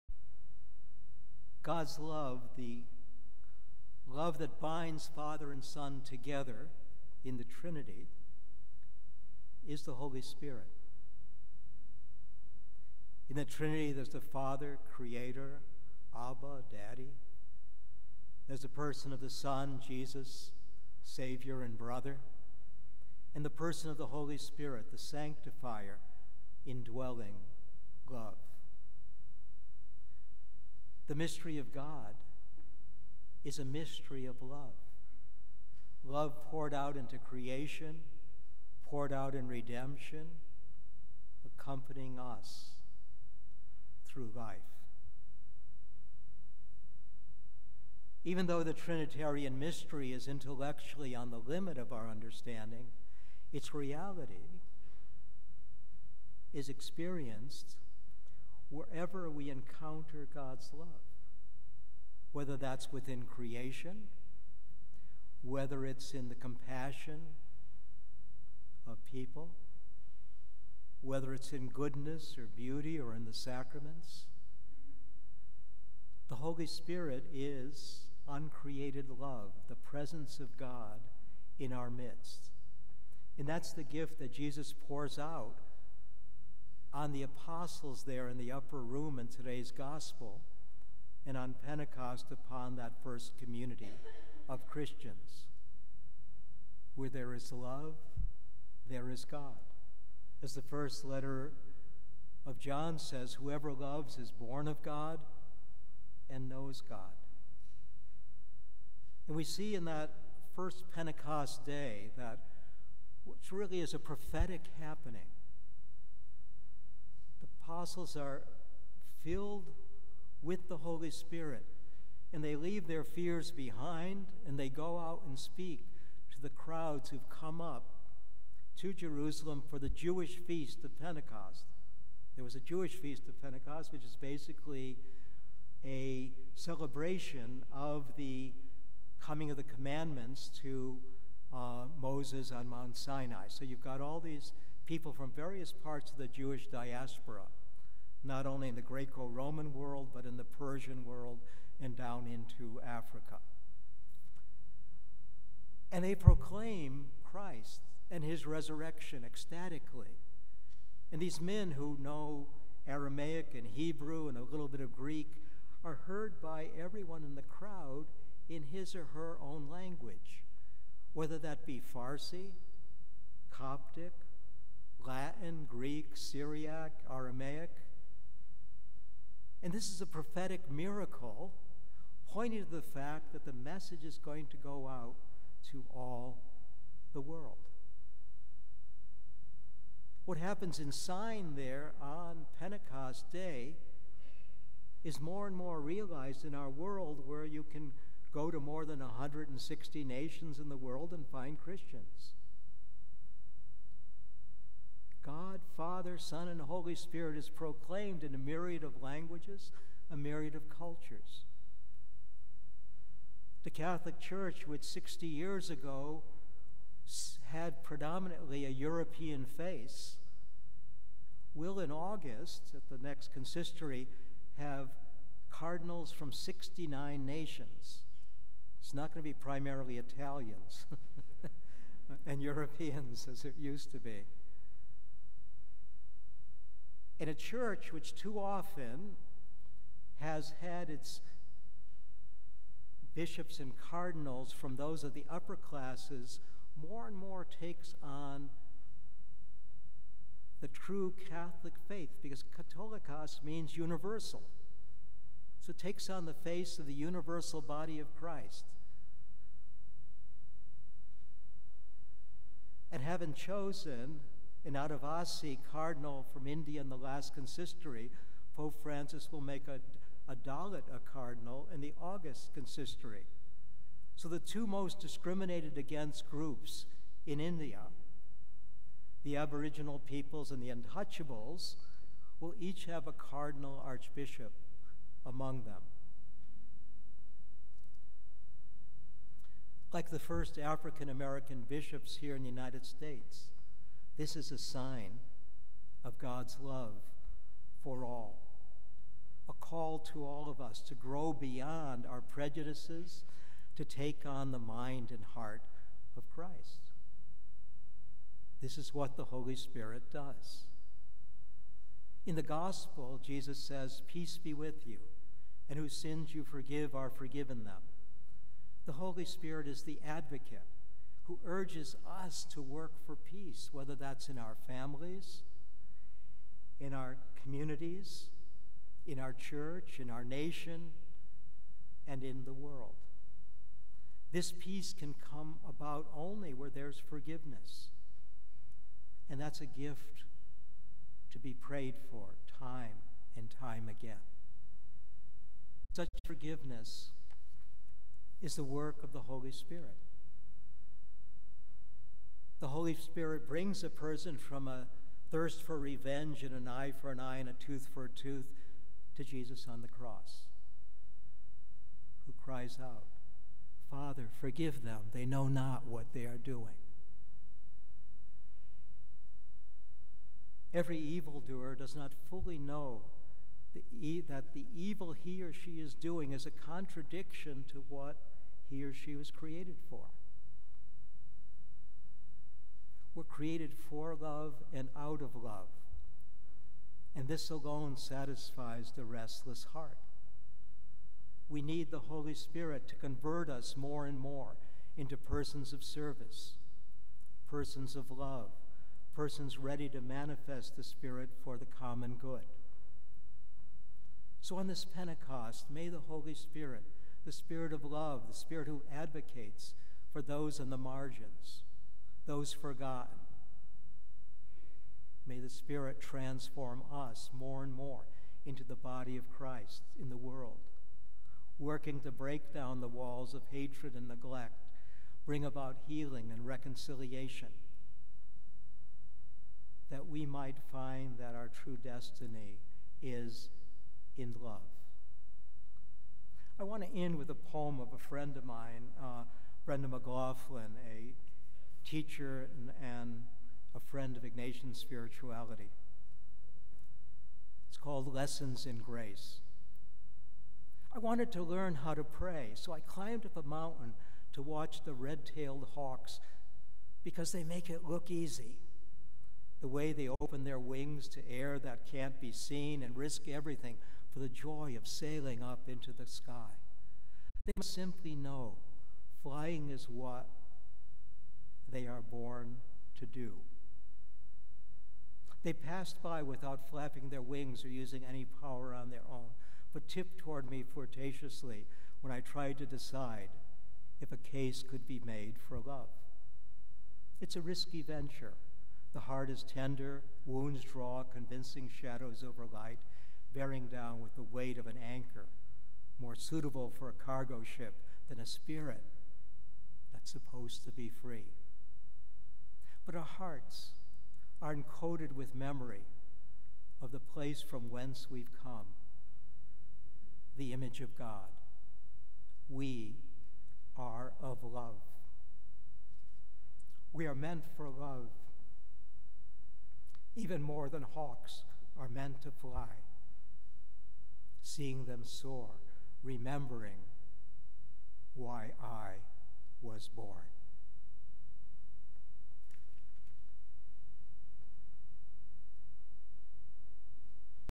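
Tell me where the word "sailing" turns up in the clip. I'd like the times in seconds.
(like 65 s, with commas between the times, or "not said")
464 s.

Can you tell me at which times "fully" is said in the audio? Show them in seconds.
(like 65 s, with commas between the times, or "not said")
372 s.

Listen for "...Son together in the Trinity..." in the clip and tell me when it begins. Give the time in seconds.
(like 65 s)
5 s.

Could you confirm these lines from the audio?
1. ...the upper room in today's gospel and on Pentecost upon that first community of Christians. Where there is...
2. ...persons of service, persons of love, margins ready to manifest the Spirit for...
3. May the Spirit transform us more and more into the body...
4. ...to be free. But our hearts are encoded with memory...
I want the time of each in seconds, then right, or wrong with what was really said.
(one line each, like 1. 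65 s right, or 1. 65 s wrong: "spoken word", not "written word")
1. 88 s right
2. 395 s wrong: "persons", not "margins"
3. 415 s right
4. 500 s right.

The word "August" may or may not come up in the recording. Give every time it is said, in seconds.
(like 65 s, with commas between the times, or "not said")
221 s, 272 s.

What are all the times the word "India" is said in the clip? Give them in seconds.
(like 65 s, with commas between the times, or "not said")
266 s, 277 s.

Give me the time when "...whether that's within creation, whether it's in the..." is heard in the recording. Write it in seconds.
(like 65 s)
62 s.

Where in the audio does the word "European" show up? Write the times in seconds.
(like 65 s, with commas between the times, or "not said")
218 s, 232 s.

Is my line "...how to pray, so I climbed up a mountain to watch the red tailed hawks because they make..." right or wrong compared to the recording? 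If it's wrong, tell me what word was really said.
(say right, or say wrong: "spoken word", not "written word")
right.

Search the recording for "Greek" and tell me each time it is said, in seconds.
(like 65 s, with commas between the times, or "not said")
164 s, 175 s.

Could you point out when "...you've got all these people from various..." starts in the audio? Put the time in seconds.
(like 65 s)
143 s.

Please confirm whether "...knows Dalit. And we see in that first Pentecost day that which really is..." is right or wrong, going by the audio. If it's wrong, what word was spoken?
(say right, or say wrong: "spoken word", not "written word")
wrong: "God", not "Dalit".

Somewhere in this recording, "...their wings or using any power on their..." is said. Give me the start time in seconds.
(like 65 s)
477 s.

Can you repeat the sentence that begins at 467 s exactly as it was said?
They must simply know flying is what they are born to do.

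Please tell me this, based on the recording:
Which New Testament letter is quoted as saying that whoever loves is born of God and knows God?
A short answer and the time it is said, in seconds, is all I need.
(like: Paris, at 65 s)
First letter of John, at 100 s.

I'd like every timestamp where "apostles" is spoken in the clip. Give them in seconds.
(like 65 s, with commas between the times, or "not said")
87 s, 117 s.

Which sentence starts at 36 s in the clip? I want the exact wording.
Love poured out into creation, poured out in redemption, accompanying us through life.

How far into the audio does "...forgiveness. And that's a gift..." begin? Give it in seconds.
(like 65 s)
337 s.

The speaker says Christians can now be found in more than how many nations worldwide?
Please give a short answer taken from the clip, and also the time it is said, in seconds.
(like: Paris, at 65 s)
160, at 198 s.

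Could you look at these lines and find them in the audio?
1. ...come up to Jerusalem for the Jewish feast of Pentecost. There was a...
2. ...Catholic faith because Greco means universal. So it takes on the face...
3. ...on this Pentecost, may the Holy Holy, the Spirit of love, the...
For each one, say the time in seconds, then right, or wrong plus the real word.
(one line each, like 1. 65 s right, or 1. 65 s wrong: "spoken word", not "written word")
1. 127 s right
2. 251 s wrong: "Catholicos", not "Greco"
3. 404 s wrong: "Spirit", not "Holy".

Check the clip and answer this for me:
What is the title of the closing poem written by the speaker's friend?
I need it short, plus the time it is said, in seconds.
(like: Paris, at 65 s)
Lessons in Grace, at 448 s.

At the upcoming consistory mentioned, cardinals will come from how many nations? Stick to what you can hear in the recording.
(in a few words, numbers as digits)
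69.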